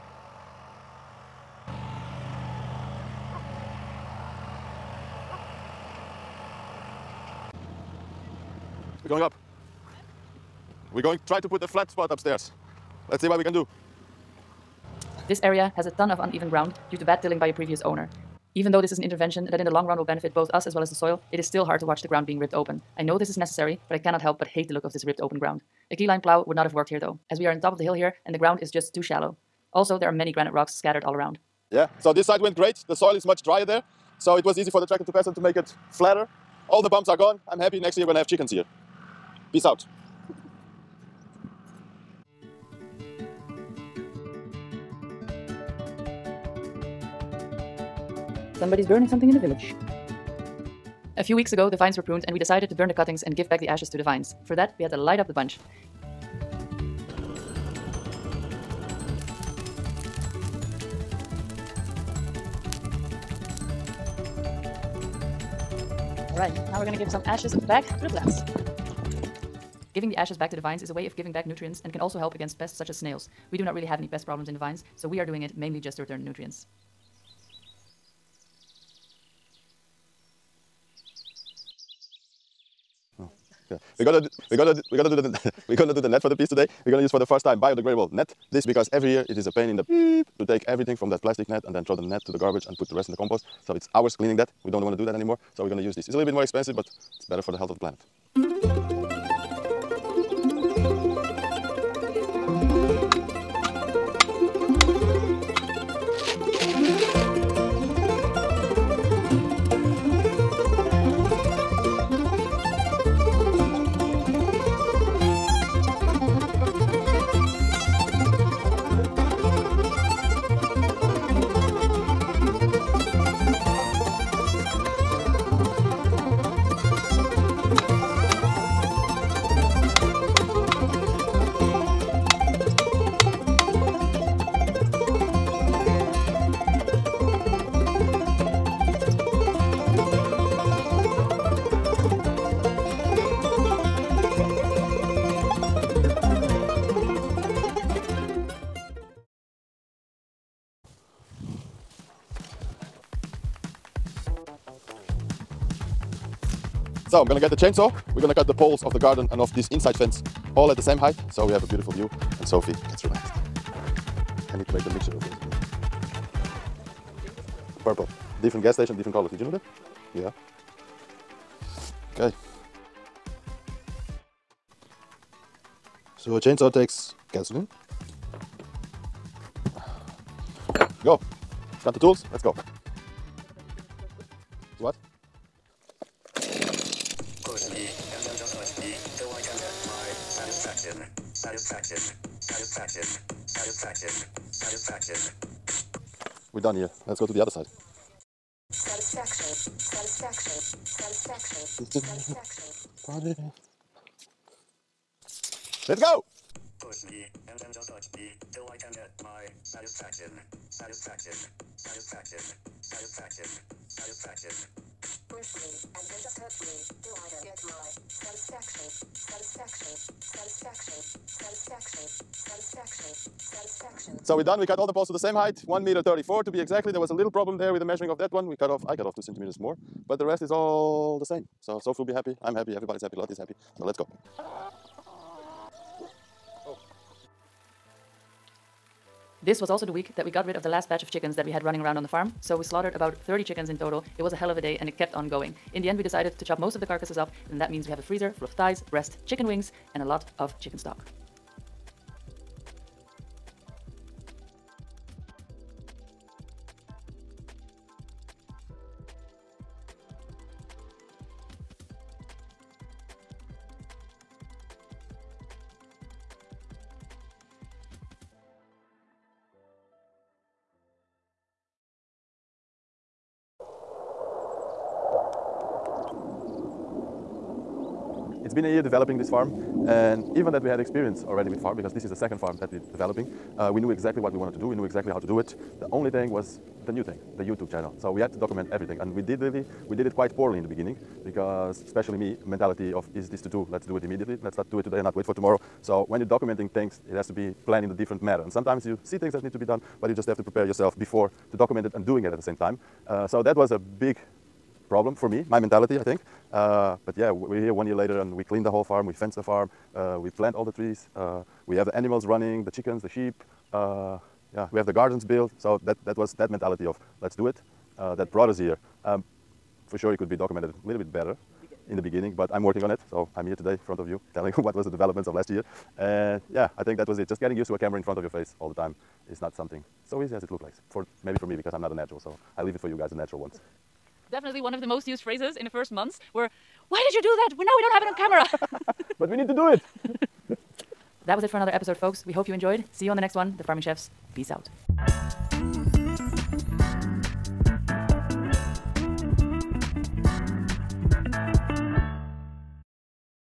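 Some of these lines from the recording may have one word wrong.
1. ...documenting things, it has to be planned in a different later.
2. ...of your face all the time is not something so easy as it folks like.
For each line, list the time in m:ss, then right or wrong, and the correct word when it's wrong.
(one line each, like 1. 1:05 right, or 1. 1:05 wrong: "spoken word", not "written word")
1. 4:56 wrong: "manner", not "later"
2. 5:28 wrong: "looks", not "folks".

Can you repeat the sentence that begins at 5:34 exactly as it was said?
Definitely one of the most used phrases in the first months were why did you do that?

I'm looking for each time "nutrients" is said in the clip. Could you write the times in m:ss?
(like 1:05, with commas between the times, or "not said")
1:11, 1:16.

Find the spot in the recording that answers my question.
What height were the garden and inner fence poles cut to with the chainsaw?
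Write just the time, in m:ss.
3:45.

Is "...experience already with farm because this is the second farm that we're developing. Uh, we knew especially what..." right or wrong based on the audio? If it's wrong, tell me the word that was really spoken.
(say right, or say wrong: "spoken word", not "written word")
wrong: "exactly", not "especially".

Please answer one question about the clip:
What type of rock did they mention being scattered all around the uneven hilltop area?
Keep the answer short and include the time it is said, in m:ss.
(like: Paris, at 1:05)
granite, at 0:30.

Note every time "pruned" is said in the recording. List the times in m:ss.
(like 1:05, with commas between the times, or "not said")
0:52.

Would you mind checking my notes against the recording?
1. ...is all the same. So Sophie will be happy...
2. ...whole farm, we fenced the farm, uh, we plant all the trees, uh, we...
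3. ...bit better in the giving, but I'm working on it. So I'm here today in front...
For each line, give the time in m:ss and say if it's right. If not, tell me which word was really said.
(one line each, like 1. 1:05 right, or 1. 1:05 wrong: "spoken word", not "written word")
1. 3:50 right
2. 5:08 right
3. 5:20 wrong: "beginning", not "giving".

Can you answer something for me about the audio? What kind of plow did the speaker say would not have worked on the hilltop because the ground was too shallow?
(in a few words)
keyline plow.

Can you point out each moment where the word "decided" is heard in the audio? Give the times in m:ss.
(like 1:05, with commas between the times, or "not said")
0:52, 4:06.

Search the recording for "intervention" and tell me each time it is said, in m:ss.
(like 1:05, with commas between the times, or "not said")
0:19.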